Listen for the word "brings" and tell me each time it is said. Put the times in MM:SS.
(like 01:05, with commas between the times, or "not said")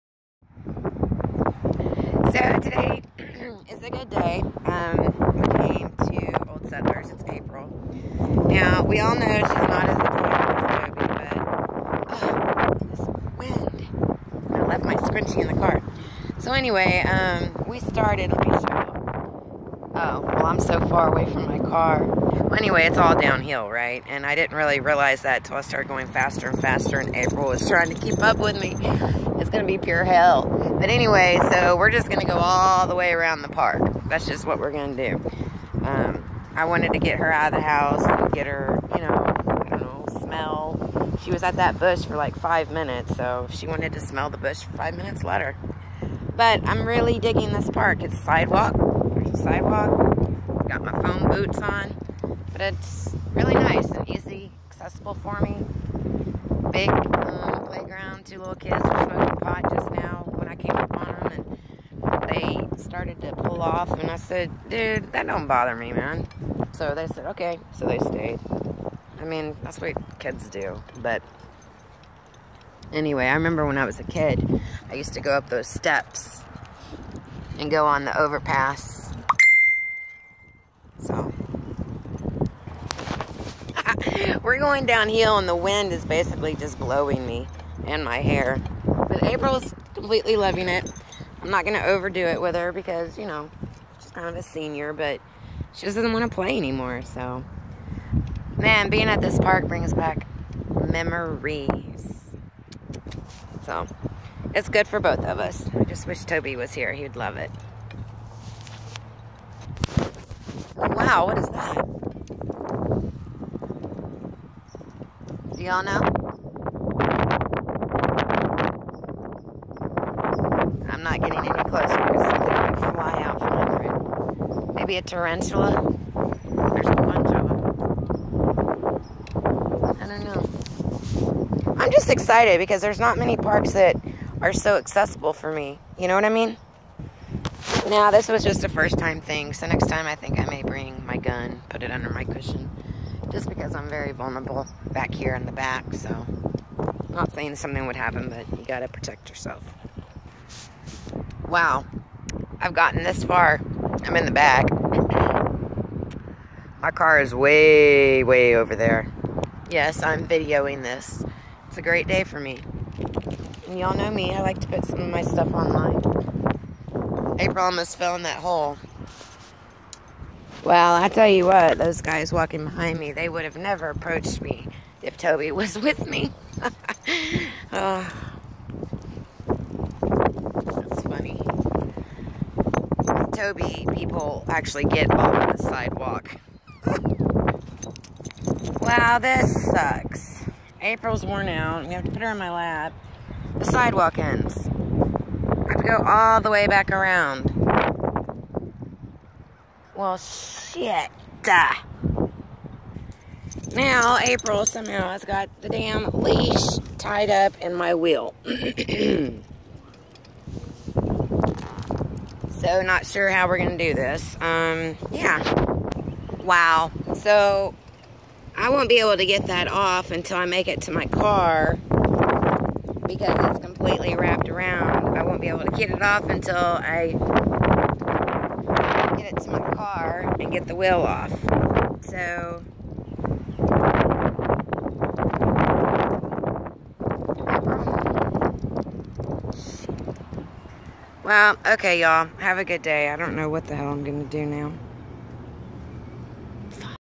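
01:39, 02:20.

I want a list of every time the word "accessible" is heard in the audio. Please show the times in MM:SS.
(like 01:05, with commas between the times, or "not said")
00:54, 02:14.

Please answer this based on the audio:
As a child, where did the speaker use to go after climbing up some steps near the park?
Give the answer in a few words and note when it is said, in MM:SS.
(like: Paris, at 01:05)
The overpass, at 01:18.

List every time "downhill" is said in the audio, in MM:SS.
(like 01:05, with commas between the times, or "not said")
00:23, 01:24.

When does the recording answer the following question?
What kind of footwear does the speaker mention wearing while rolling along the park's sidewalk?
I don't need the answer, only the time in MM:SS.
00:51.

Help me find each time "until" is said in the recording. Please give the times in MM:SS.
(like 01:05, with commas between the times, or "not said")
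00:25, 03:40, 03:46.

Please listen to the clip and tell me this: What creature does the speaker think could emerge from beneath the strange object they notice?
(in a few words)
A tarantula.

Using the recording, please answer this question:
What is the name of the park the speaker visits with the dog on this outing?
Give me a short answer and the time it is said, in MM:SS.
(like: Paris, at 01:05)
Old Settlers, at 00:06.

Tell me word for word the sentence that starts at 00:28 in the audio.
It's going to be pure hell.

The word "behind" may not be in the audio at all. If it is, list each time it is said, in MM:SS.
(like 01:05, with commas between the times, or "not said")
02:52.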